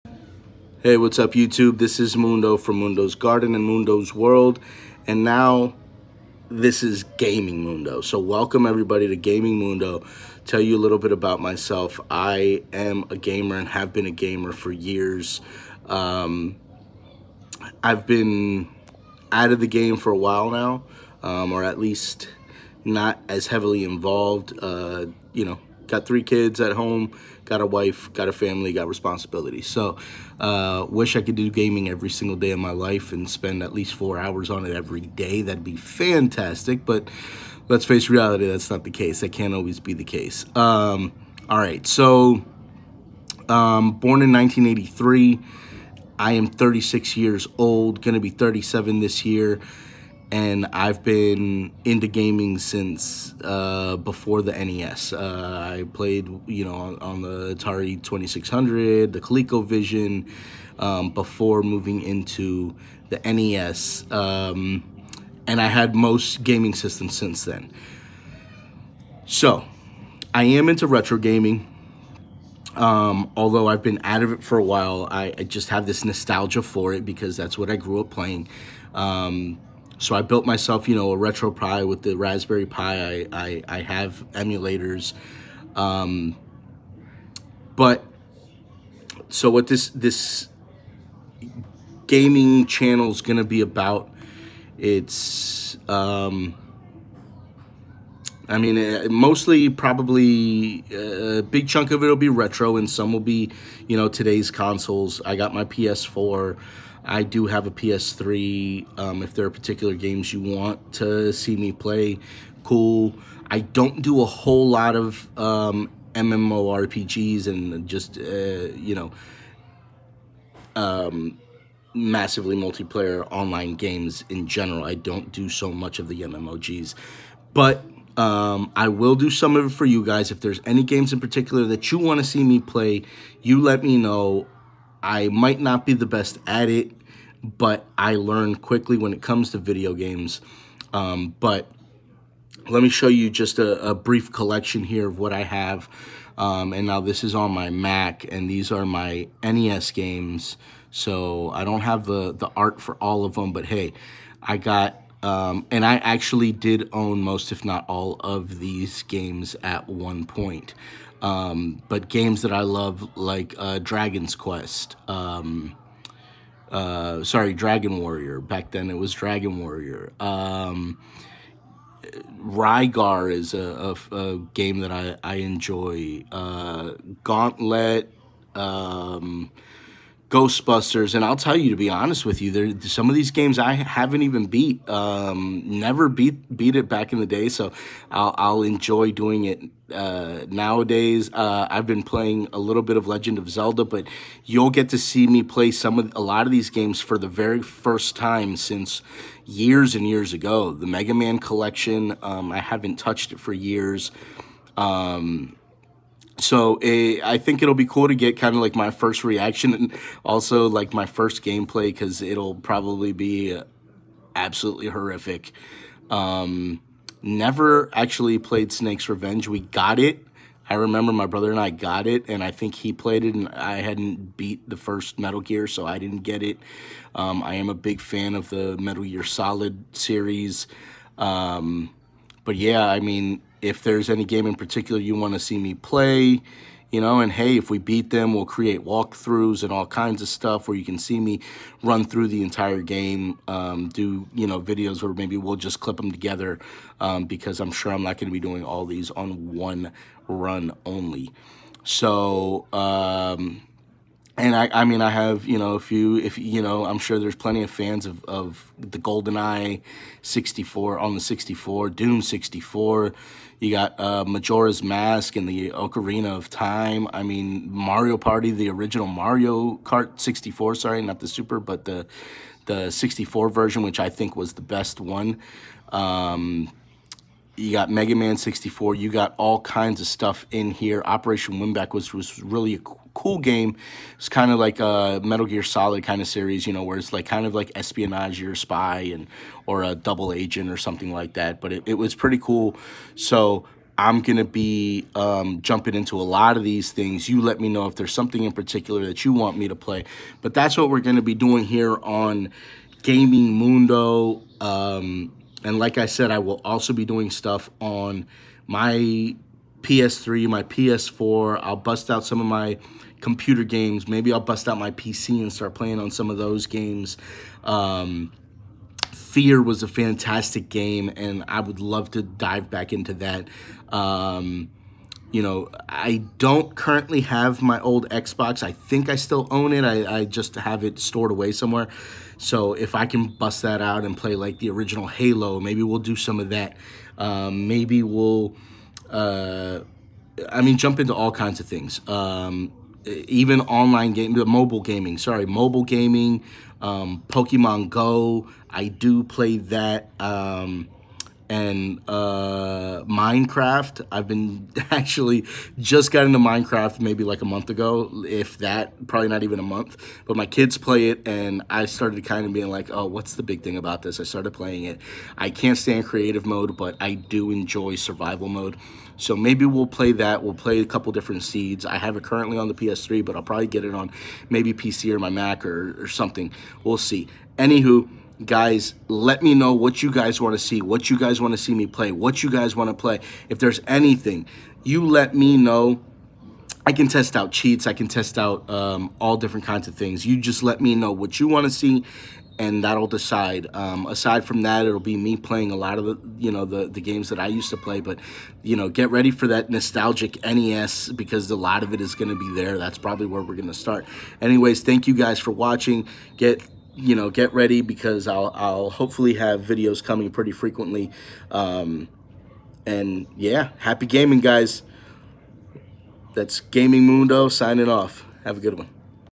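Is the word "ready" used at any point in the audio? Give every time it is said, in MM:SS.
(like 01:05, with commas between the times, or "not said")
06:39, 06:47.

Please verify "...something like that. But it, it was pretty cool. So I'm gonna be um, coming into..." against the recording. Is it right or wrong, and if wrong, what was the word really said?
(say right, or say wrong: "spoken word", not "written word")
wrong: "jumping", not "coming".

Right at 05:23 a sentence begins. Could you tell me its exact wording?
Um, you know, I don't currently have my old Xbox.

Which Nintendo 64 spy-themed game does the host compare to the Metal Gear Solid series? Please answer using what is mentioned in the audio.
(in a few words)
Operation WinBack.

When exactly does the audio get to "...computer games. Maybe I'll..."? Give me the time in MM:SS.
05:13.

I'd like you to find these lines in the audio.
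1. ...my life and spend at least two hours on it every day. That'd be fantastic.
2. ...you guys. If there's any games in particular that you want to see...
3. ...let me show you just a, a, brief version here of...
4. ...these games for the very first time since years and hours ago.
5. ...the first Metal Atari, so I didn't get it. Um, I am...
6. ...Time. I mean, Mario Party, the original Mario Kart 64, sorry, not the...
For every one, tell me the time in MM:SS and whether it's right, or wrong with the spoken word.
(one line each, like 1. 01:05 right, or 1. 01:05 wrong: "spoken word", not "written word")
1. 00:32 wrong: "four", not "two"
2. 02:09 right
3. 02:22 wrong: "collection", not "version"
4. 03:16 wrong: "years", not "hours"
5. 03:44 wrong: "Gear", not "Atari"
6. 04:26 right.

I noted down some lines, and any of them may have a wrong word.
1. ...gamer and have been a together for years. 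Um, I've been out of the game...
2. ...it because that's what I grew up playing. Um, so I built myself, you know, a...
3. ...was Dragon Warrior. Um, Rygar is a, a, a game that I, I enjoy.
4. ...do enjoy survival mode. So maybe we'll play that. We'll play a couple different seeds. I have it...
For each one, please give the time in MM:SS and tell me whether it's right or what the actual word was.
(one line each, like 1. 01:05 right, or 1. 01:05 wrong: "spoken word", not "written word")
1. 00:13 wrong: "gamer", not "together"
2. 01:16 right
3. 02:48 right
4. 06:07 right.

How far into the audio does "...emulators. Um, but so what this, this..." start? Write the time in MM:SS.
01:24.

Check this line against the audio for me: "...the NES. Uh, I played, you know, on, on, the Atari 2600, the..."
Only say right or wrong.
right.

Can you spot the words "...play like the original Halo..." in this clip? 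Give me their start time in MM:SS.
05:34.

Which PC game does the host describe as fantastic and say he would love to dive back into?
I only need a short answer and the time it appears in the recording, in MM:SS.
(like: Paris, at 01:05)
Fear, at 05:19.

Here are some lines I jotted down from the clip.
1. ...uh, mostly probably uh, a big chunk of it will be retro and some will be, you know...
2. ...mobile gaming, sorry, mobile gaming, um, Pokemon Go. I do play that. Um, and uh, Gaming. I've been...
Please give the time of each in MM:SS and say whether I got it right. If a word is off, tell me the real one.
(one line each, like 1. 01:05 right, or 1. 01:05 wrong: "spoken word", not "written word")
1. 01:38 right
2. 05:44 wrong: "Minecraft", not "Gaming".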